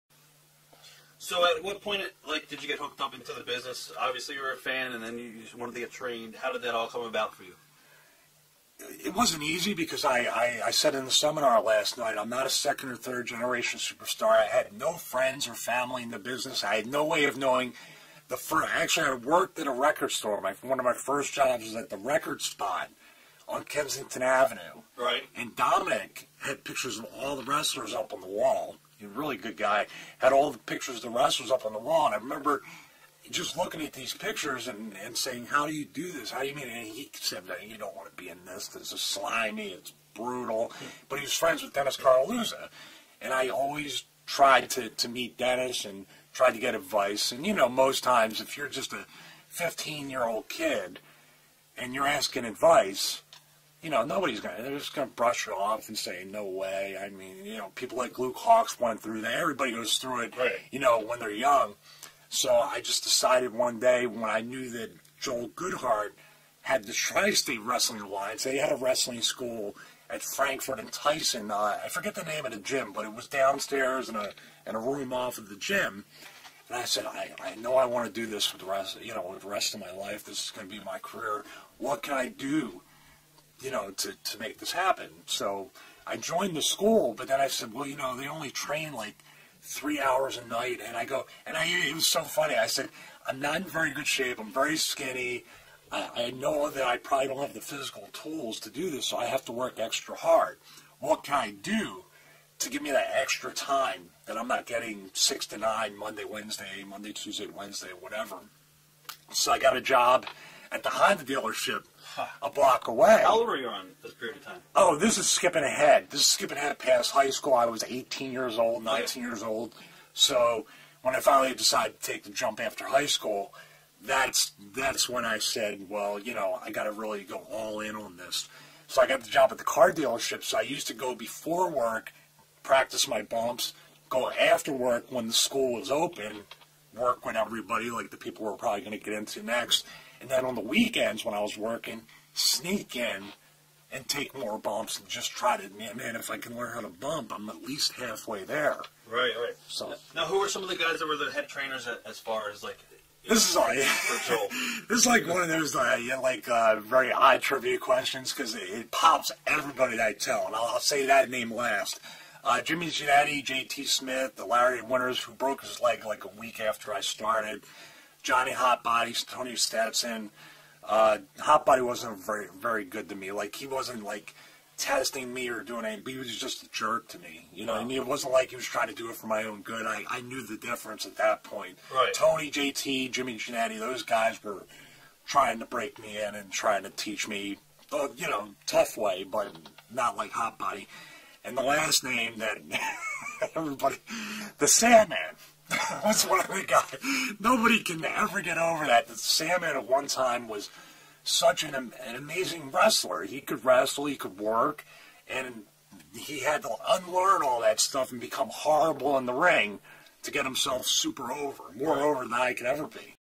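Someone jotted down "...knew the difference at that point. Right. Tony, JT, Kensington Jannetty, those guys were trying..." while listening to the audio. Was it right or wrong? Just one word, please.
wrong.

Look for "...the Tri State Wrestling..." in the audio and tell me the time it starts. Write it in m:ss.
1:06.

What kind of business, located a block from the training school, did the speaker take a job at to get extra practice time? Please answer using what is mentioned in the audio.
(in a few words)
Honda dealership.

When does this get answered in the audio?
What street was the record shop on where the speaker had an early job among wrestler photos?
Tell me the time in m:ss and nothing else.
0:23.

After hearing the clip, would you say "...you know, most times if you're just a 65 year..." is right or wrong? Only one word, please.
wrong.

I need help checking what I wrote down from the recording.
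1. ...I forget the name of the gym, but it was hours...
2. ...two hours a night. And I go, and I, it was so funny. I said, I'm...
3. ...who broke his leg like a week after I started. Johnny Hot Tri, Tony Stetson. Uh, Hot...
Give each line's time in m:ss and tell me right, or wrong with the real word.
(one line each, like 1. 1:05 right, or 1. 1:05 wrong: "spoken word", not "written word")
1. 1:11 wrong: "downstairs", not "hours"
2. 1:29 wrong: "three", not "two"
3. 2:45 wrong: "Body", not "Tri".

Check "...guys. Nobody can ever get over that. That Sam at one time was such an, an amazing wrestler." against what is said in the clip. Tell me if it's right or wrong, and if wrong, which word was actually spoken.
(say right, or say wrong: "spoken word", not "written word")
right.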